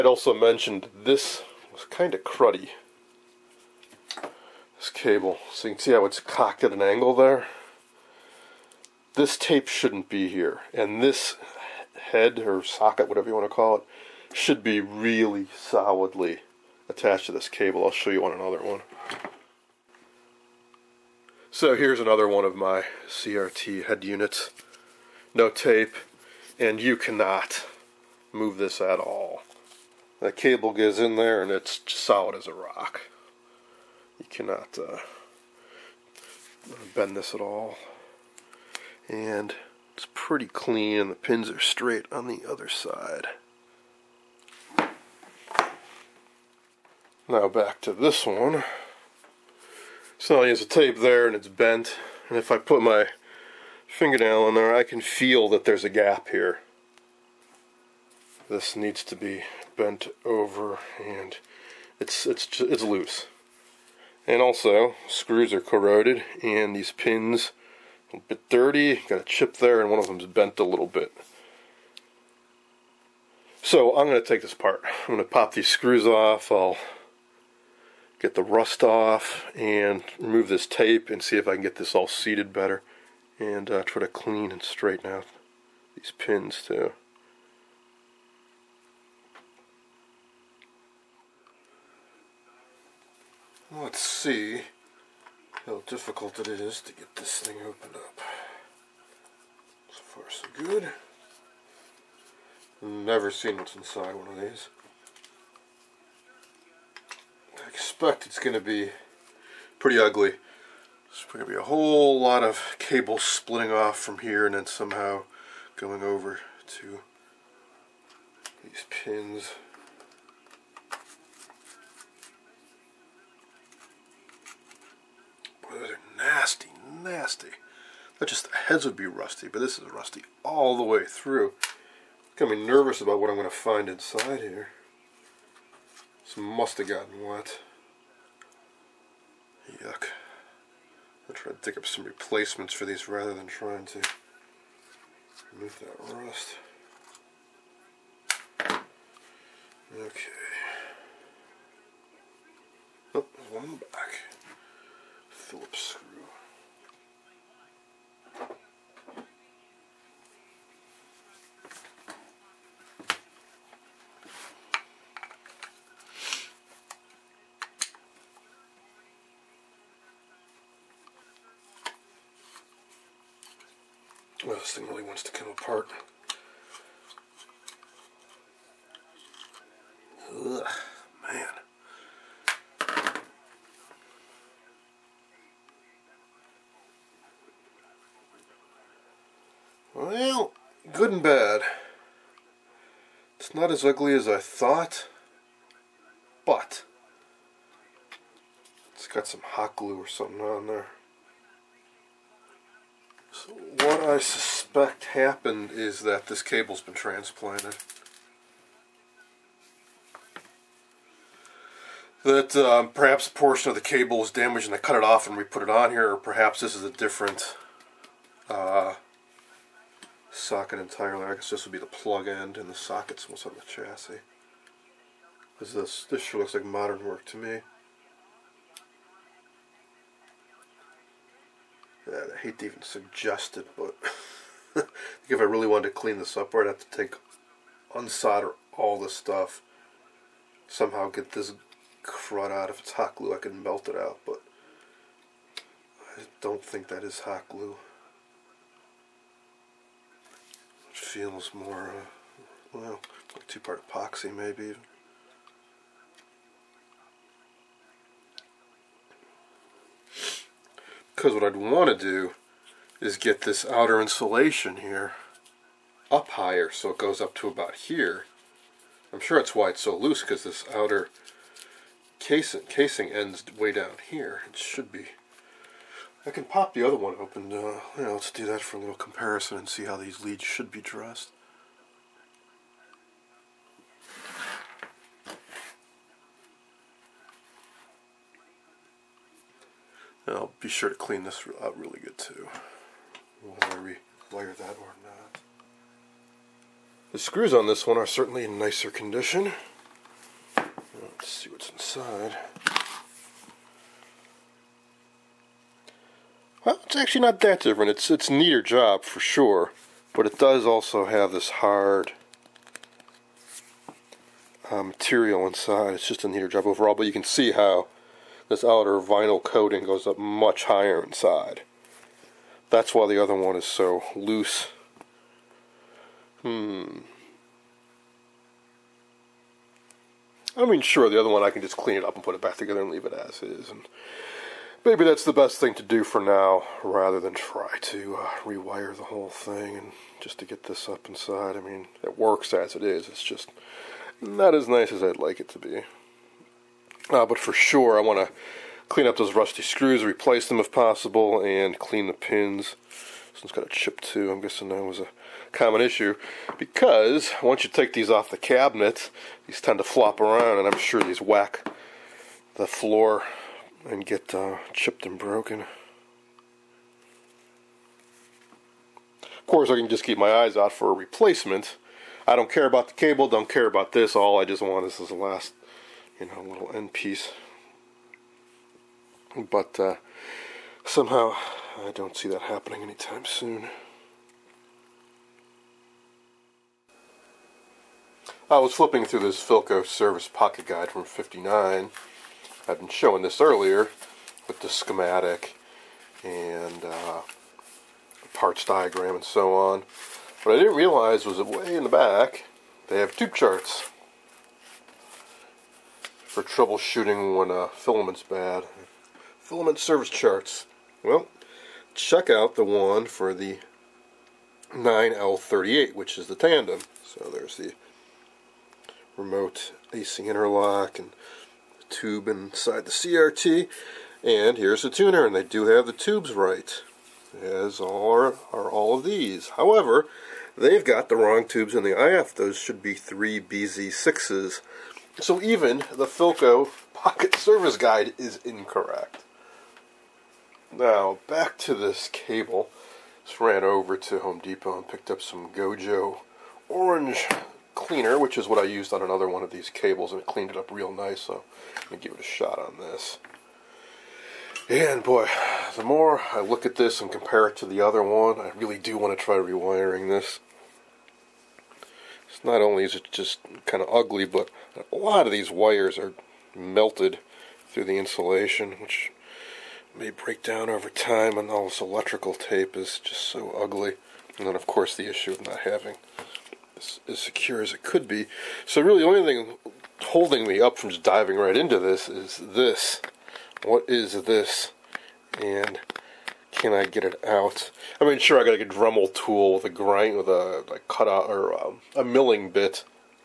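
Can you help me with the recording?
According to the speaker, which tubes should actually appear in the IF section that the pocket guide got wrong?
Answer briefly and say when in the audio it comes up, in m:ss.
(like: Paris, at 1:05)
3BZ6, at 7:12.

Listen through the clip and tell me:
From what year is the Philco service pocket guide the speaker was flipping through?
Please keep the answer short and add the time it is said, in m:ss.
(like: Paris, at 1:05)
1959, at 6:31.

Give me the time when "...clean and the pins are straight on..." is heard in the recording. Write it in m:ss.
0:40.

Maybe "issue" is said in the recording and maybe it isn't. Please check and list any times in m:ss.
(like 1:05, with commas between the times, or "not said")
5:55, 7:55.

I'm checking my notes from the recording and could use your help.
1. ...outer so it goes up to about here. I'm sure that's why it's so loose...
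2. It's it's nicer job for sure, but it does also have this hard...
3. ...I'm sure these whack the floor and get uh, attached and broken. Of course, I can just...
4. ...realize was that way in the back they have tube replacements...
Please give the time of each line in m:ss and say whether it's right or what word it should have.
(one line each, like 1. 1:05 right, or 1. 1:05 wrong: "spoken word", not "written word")
1. 4:26 wrong: "higher", not "outer"
2. 5:07 wrong: "neater", not "nicer"
3. 6:00 wrong: "chipped", not "attached"
4. 6:40 wrong: "charts", not "replacements".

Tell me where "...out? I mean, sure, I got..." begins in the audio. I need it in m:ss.
8:07.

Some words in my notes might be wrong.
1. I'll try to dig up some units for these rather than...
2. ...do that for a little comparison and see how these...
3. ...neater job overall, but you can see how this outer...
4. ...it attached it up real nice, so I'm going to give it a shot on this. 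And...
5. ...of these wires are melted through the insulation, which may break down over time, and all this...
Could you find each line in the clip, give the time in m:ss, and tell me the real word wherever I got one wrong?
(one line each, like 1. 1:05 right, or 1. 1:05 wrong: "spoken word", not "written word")
1. 2:21 wrong: "replacements", not "units"
2. 4:38 right
3. 5:16 right
4. 7:30 wrong: "cleaned", not "attached"
5. 7:45 right.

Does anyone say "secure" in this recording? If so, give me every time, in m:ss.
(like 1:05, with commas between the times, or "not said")
7:57.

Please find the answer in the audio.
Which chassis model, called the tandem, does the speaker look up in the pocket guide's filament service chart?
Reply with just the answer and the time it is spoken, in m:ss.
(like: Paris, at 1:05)
9L38, at 6:54.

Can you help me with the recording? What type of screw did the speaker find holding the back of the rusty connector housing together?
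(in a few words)
Phillips.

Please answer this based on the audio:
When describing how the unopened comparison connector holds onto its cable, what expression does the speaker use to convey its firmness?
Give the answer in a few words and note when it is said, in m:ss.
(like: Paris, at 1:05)
solid as a rock, at 0:31.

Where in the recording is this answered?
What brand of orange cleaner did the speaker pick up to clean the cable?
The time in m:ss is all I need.
7:25.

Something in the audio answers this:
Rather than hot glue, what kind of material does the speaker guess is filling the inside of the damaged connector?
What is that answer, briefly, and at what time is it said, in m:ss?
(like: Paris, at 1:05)
two-part epoxy, at 4:13.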